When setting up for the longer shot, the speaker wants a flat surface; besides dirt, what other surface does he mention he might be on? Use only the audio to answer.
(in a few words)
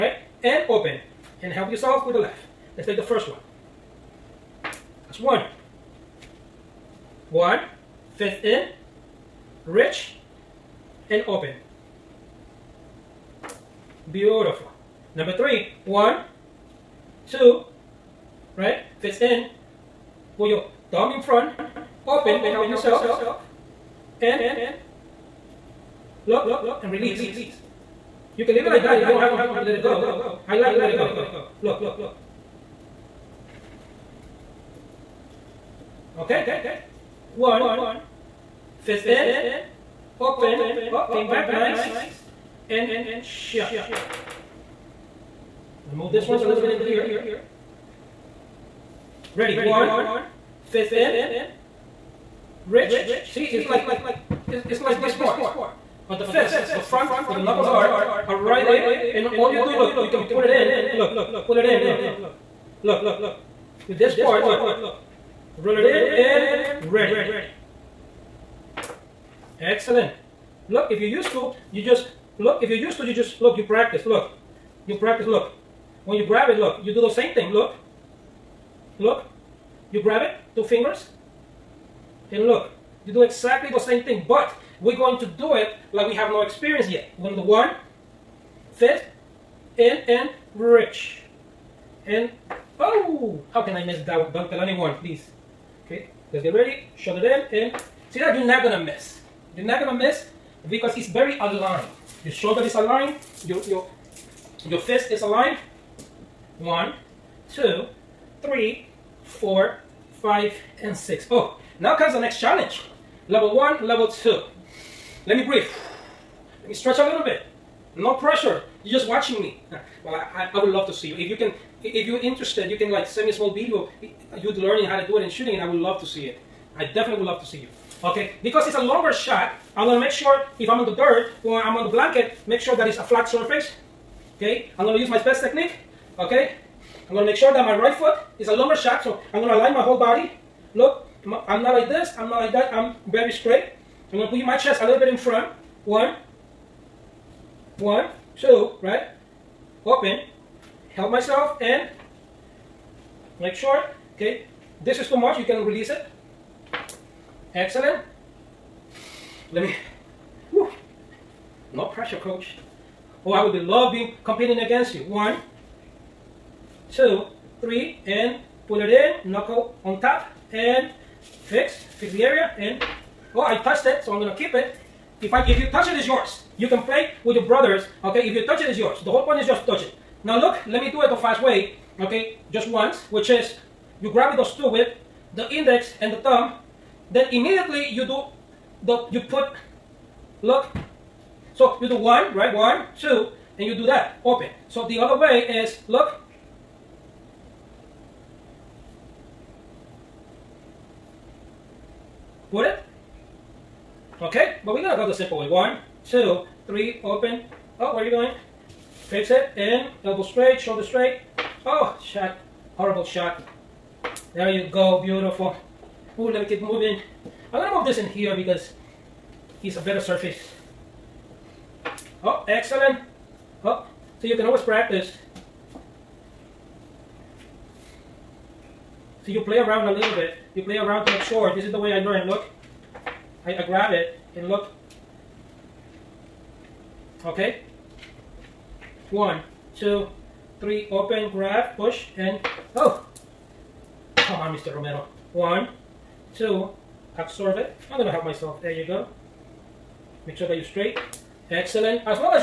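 blanket.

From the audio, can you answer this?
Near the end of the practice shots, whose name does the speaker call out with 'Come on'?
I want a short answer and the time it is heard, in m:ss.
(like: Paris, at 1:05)
Mr. Romero, at 4:04.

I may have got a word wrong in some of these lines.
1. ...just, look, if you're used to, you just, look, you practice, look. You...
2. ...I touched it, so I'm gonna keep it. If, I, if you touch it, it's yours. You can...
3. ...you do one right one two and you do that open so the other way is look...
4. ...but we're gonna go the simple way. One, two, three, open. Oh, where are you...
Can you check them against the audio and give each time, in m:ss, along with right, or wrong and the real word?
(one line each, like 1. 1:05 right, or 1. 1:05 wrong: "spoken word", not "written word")
1. 1:11 right
2. 2:53 right
3. 3:11 right
4. 3:24 right.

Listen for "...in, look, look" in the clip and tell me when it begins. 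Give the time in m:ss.
1:01.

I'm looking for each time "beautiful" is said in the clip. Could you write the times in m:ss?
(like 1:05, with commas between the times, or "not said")
0:14, 3:35.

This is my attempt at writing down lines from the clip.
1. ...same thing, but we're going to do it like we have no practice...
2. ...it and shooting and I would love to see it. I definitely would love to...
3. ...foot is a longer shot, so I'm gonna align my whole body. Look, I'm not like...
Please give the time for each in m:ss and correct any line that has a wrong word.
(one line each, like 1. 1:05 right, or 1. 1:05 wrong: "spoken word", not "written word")
1. 1:23 wrong: "experience", not "practice"
2. 2:05 right
3. 2:17 right.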